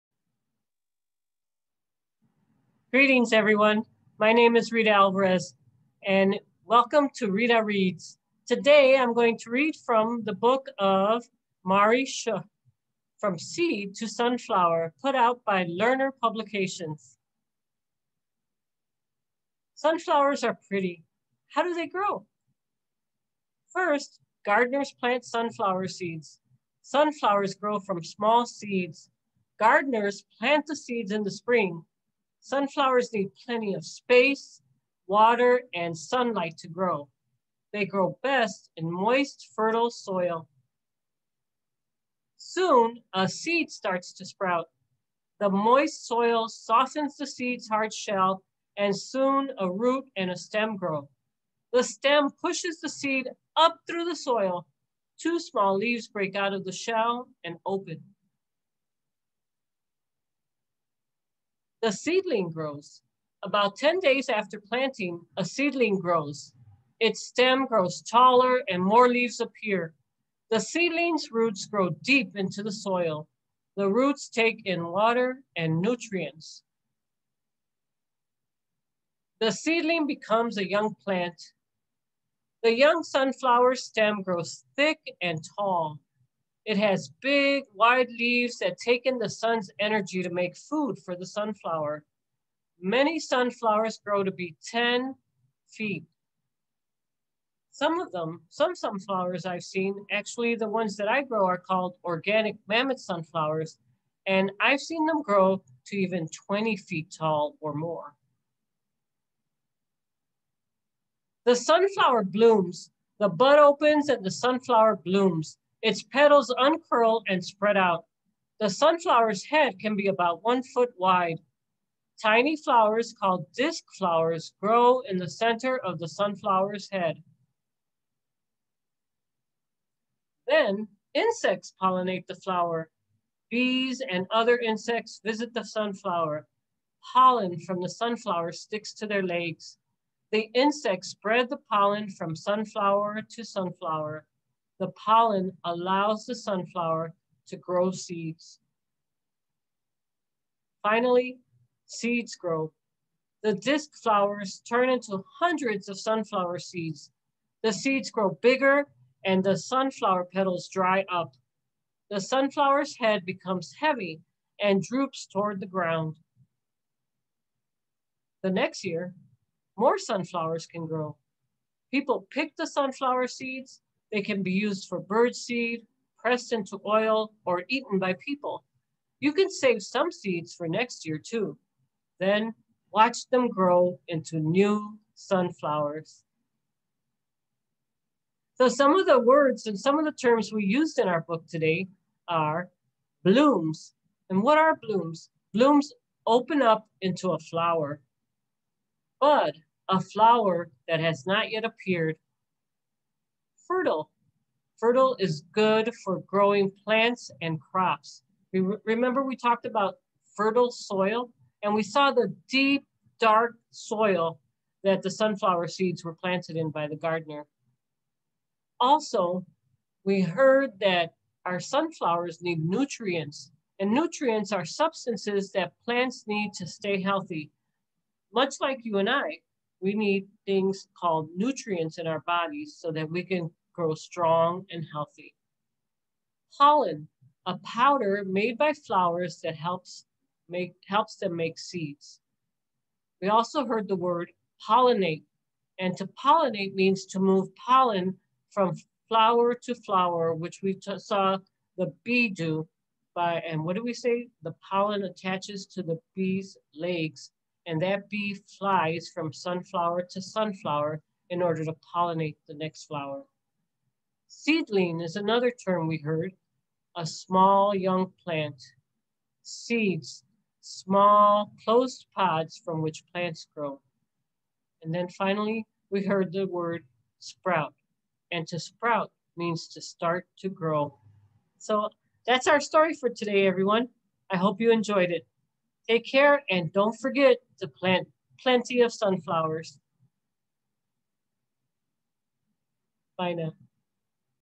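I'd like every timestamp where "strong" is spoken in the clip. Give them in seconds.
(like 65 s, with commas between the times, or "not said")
233 s.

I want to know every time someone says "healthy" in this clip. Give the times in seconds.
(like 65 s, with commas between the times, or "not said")
226 s, 234 s.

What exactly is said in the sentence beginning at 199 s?
Bud, a flower that has not yet appeared fertile.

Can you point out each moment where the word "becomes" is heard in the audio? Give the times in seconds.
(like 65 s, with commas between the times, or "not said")
80 s, 163 s.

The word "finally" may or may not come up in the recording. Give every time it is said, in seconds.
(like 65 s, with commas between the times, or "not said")
150 s, 275 s.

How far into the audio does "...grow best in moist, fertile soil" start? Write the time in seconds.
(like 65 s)
37 s.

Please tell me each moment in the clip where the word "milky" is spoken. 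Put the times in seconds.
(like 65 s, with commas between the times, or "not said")
not said.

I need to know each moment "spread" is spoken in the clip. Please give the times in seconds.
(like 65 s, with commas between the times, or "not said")
117 s, 141 s.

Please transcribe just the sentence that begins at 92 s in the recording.
Many sunflowers grow to be 10 feet.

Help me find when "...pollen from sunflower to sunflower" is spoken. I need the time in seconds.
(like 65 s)
141 s.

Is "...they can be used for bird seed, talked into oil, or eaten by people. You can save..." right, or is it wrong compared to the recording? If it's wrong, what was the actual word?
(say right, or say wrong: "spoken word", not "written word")
wrong: "pressed", not "talked".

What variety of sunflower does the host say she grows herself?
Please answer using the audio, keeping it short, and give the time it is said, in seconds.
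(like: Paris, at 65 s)
organic mammoth sunflowers, at 102 s.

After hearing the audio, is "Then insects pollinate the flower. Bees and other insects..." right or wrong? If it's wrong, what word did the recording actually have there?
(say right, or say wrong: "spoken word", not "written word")
right.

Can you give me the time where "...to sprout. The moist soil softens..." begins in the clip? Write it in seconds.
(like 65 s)
44 s.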